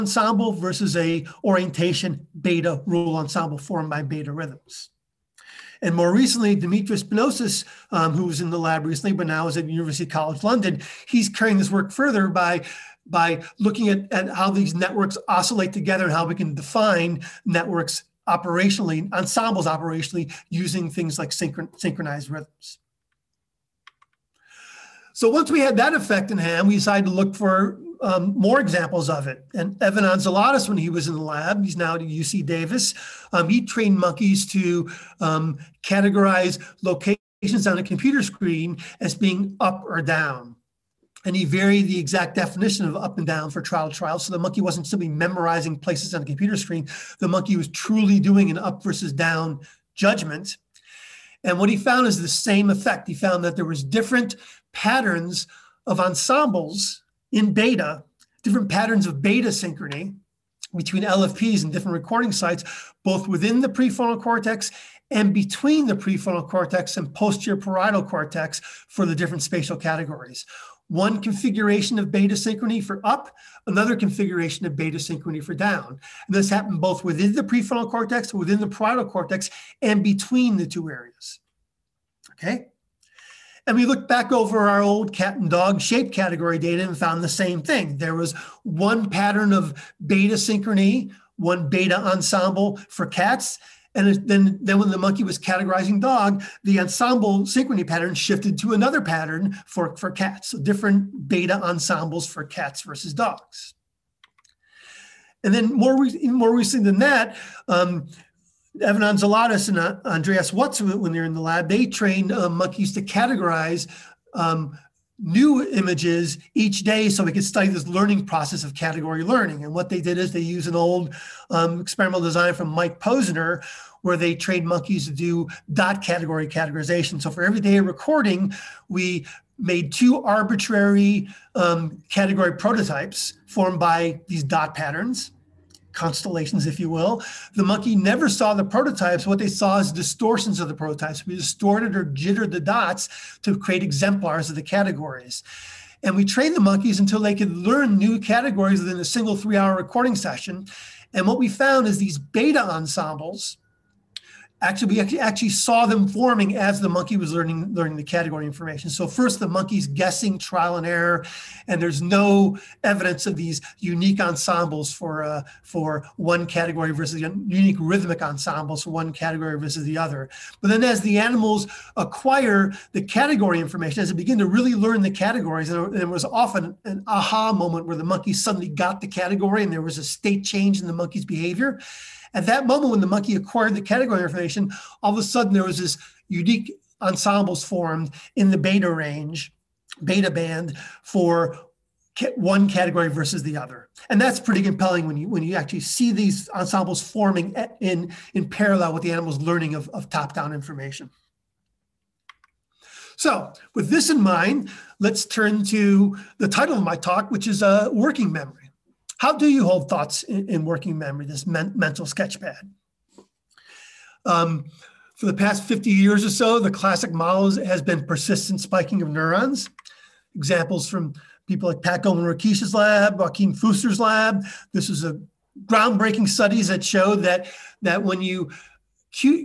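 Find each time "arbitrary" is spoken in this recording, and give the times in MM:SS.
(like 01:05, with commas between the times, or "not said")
02:10.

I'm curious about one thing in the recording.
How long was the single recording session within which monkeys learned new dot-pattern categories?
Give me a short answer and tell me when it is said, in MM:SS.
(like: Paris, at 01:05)
3 hours, at 02:29.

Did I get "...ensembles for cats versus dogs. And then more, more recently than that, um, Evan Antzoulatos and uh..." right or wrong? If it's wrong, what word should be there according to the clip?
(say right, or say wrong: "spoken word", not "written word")
right.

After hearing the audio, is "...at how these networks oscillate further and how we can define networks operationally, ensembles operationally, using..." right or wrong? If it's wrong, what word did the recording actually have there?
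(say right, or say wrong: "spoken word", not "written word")
wrong: "together", not "further".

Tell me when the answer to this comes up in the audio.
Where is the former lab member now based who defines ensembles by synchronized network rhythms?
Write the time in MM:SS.
00:09.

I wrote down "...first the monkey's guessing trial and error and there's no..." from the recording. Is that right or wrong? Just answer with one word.
right.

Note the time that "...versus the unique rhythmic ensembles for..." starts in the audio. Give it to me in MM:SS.
02:46.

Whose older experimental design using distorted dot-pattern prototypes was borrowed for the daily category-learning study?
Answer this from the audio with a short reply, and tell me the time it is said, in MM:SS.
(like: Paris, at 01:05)
Mike Posner, at 02:02.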